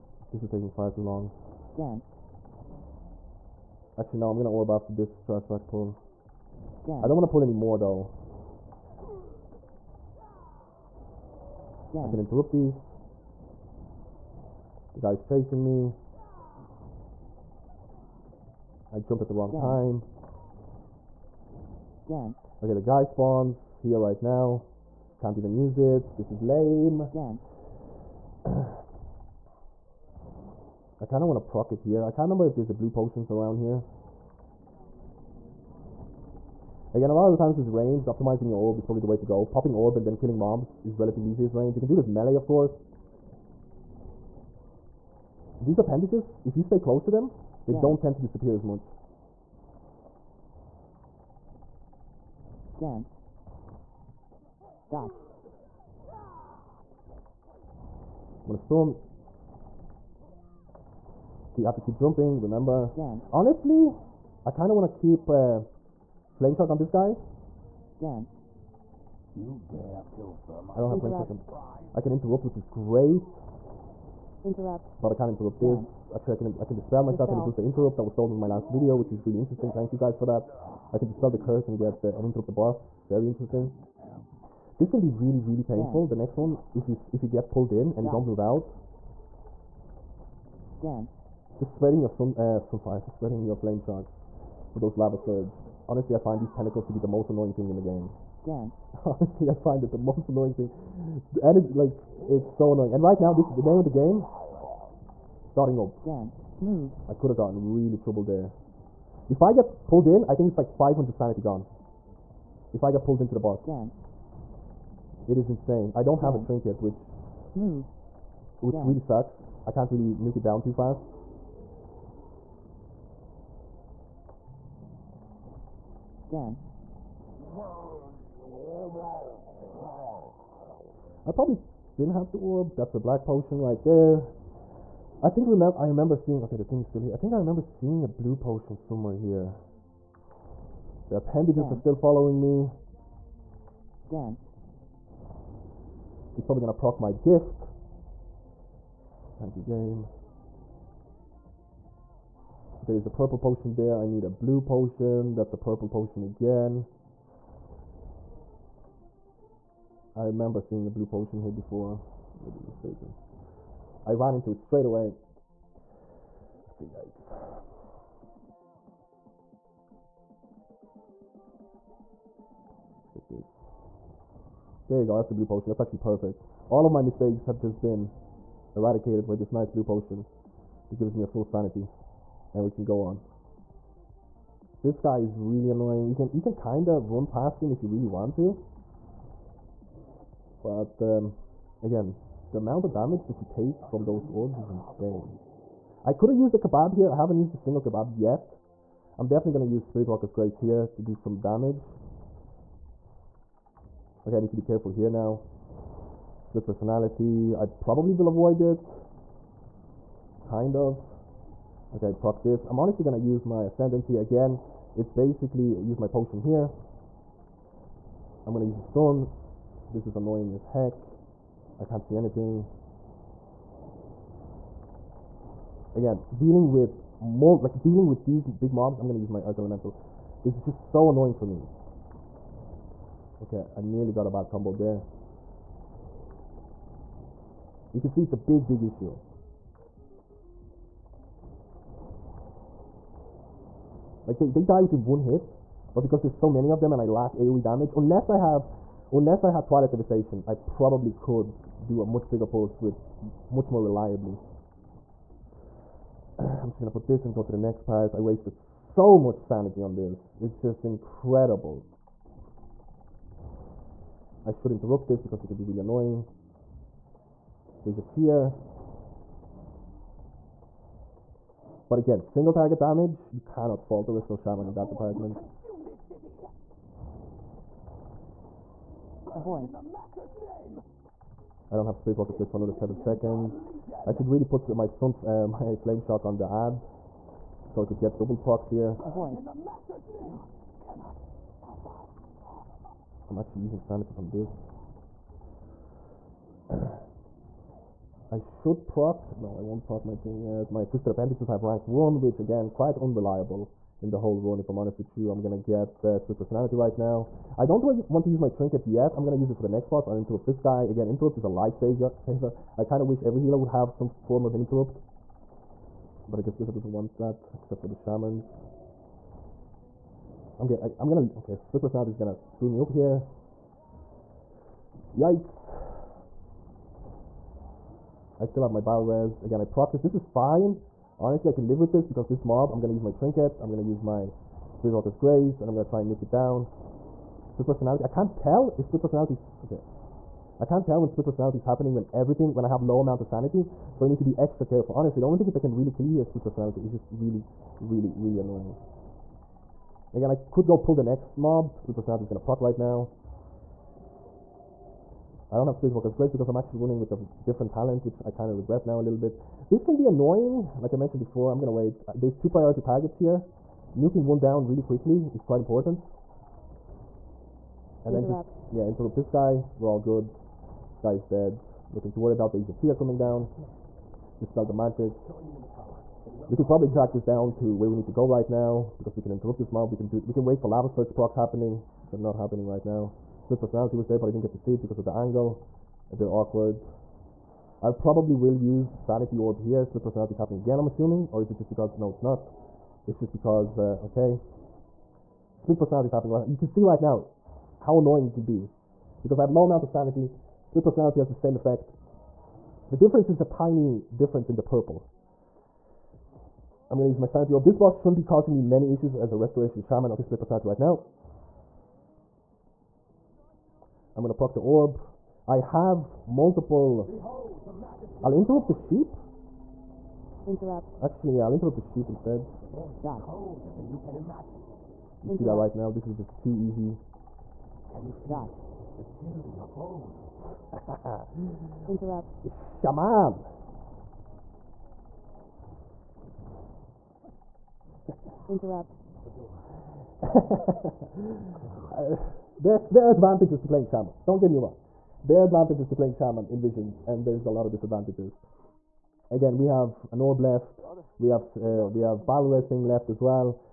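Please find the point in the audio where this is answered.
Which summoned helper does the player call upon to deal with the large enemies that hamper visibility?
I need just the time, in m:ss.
3:49.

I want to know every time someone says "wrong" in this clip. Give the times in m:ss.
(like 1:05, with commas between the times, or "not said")
0:19, 7:24.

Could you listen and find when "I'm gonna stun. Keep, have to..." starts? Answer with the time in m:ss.
0:58.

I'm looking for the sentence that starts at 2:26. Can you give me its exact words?
He's probably gonna proc my gift.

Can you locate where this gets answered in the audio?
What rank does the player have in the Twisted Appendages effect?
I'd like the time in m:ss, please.
5:01.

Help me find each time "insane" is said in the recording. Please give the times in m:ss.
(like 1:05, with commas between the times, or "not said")
1:55, 3:14.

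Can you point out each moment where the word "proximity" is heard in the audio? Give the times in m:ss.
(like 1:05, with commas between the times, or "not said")
not said.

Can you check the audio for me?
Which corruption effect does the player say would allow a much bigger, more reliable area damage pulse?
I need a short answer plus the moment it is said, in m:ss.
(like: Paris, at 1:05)
Twilight Devastation, at 4:09.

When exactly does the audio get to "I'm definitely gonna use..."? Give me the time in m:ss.
3:19.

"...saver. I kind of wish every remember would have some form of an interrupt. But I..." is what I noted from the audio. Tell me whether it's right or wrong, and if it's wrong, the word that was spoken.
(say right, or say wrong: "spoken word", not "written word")
wrong: "healer", not "remember".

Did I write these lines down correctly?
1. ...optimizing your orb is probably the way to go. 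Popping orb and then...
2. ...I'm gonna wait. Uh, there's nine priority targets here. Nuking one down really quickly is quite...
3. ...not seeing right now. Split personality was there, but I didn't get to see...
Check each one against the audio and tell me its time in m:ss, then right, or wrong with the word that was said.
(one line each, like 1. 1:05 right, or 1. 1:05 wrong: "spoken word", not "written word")
1. 0:38 right
2. 6:01 wrong: "two", not "nine"
3. 6:22 wrong: "happening", not "seeing".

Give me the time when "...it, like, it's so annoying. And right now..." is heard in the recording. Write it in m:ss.
1:41.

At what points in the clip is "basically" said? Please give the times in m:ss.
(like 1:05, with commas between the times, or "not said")
3:35.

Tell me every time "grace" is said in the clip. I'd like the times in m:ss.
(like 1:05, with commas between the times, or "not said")
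3:20, 5:35, 5:56.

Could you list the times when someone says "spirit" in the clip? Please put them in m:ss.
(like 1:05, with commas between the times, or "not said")
3:19, 4:41, 5:34, 5:55.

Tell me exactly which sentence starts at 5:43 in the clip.
So you need to be extra careful.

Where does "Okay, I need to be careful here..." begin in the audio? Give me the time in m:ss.
3:24.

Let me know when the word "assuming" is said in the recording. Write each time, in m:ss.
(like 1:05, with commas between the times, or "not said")
6:30.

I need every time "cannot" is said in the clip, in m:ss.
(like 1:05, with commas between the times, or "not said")
4:33.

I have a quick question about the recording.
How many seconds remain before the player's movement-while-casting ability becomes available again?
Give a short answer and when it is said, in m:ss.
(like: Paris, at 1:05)
7, at 4:42.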